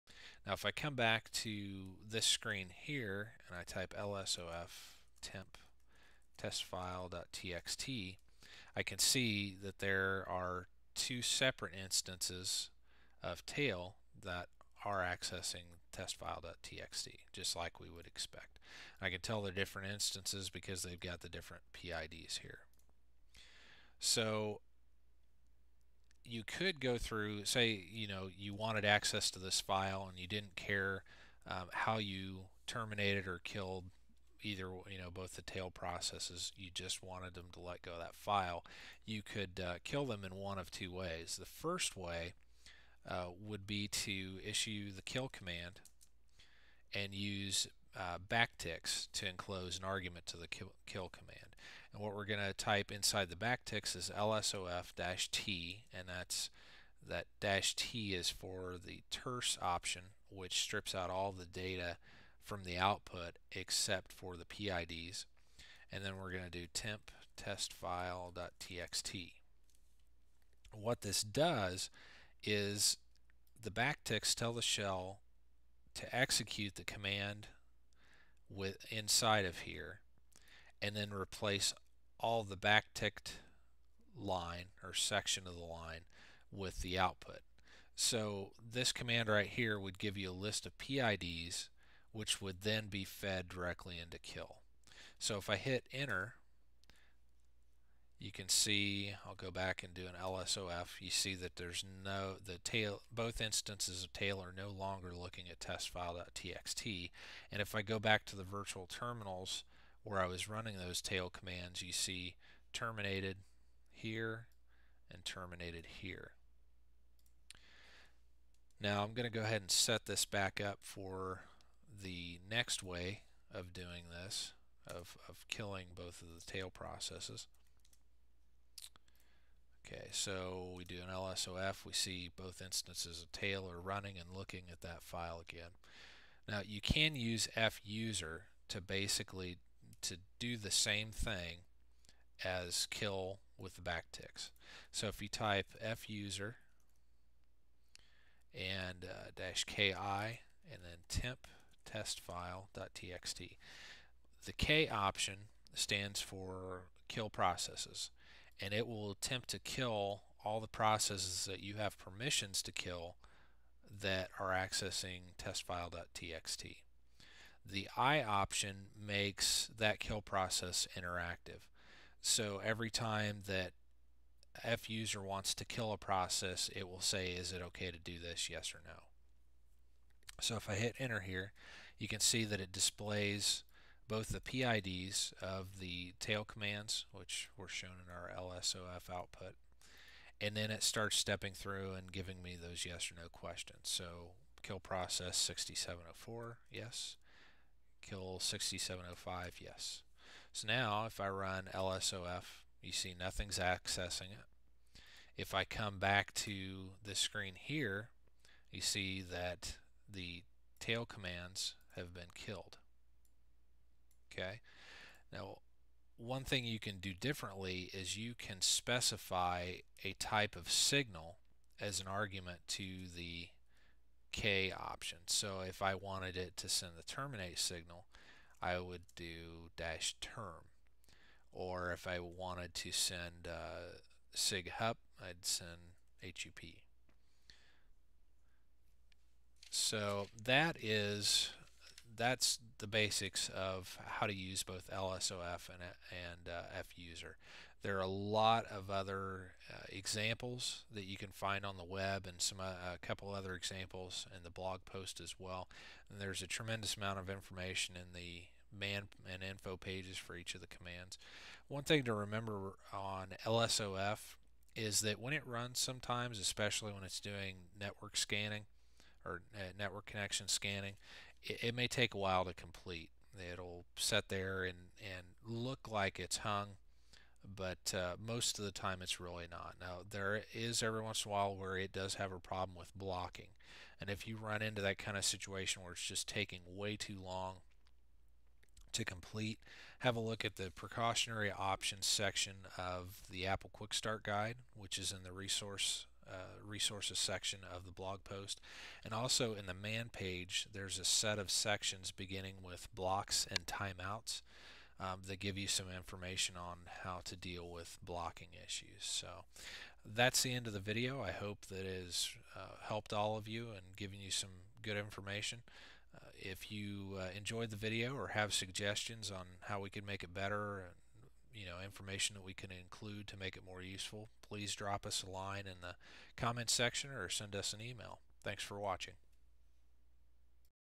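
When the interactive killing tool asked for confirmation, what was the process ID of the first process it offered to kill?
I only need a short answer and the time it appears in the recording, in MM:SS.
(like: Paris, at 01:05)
6704, at 03:15.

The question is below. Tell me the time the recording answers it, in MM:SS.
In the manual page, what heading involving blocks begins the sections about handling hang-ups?
05:02.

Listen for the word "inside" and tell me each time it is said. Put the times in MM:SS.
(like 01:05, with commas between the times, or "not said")
00:52, 01:18.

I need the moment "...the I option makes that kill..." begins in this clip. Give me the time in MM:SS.
02:47.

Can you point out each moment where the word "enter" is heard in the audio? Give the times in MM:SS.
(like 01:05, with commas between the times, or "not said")
01:35, 03:00.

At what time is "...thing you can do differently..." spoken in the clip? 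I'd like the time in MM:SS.
03:36.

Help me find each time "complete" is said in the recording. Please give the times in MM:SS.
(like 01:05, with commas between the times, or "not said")
04:32, 04:49.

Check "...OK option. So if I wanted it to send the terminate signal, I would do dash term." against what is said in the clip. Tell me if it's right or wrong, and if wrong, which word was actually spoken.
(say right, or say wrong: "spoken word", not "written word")
right.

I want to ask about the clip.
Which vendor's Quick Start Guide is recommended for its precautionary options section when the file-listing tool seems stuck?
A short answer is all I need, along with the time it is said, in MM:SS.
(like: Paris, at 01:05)
Apple, at 04:53.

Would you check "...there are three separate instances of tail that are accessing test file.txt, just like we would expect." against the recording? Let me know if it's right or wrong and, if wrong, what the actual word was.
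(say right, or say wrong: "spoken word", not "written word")
wrong: "two", not "three".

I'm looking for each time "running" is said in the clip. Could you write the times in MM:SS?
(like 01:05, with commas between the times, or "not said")
01:50, 02:13.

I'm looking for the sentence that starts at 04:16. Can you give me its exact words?
And there's a tremendous amount of information in the man and info pages for each of the commands.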